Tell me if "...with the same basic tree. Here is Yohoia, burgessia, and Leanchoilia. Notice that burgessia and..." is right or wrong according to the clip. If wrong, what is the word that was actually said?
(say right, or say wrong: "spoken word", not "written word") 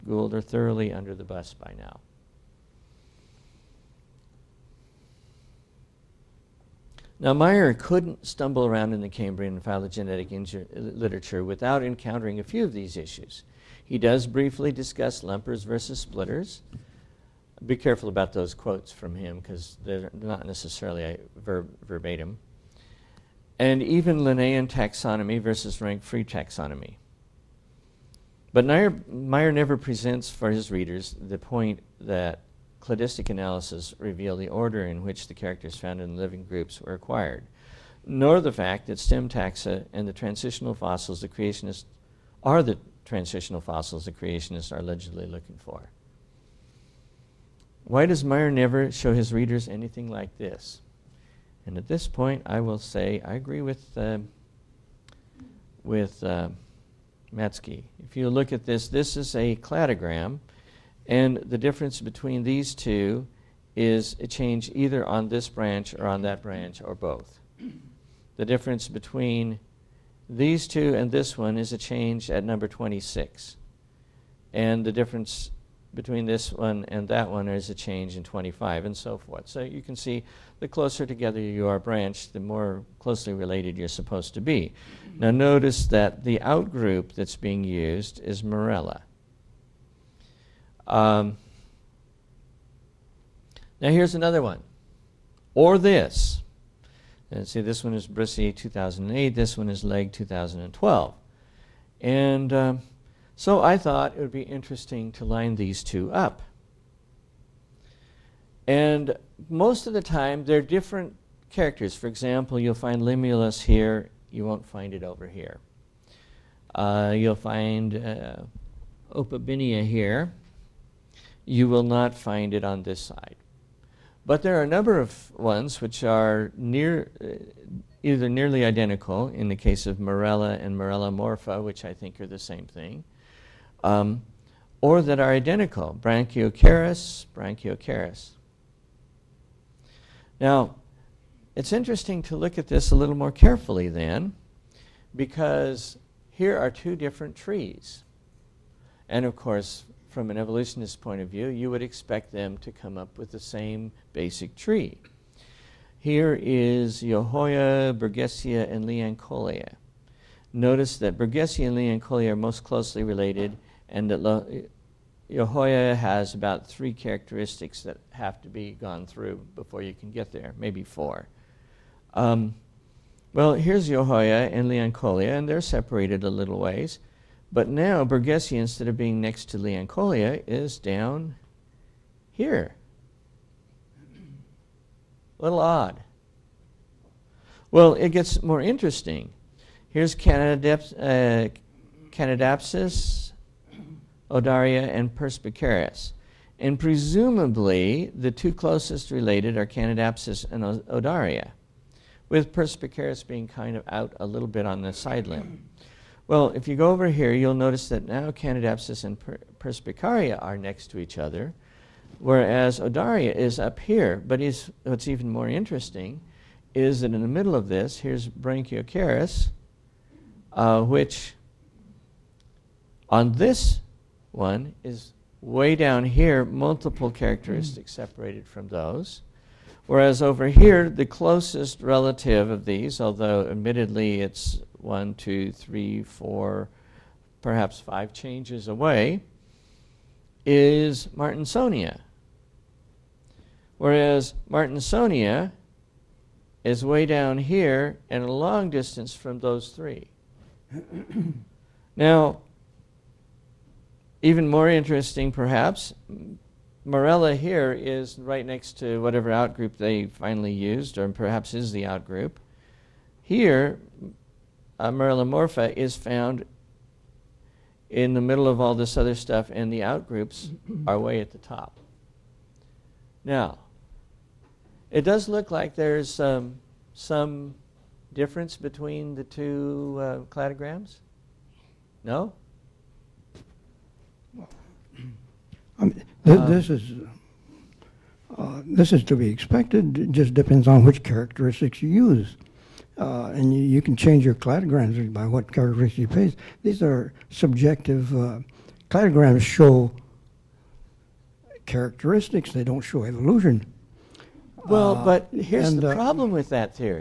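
right.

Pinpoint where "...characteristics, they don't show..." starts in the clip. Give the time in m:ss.
5:01.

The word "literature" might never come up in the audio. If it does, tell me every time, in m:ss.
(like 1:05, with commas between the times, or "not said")
0:10.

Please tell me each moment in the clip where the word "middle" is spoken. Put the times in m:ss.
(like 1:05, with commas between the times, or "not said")
3:37, 4:28.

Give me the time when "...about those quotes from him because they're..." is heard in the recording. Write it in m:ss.
0:18.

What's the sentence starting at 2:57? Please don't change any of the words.
But now Burgessia, instead of being next to Leanchoilia, is down here.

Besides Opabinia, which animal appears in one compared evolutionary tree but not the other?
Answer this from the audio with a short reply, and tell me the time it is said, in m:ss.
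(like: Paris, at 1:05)
Limulus, at 1:53.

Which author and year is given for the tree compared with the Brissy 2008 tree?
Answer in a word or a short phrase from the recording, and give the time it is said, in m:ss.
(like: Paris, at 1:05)
Legg 2012, at 1:39.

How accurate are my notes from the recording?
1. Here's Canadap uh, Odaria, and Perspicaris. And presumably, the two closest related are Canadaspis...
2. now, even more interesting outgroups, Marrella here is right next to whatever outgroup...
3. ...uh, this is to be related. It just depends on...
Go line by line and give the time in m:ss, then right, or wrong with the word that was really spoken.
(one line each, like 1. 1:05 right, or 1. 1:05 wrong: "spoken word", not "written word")
1. 3:09 right
2. 4:11 wrong: "perhaps", not "outgroups"
3. 4:48 wrong: "expected", not "related".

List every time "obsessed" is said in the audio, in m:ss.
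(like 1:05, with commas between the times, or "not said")
not said.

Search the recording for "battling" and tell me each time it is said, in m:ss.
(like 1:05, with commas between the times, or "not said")
not said.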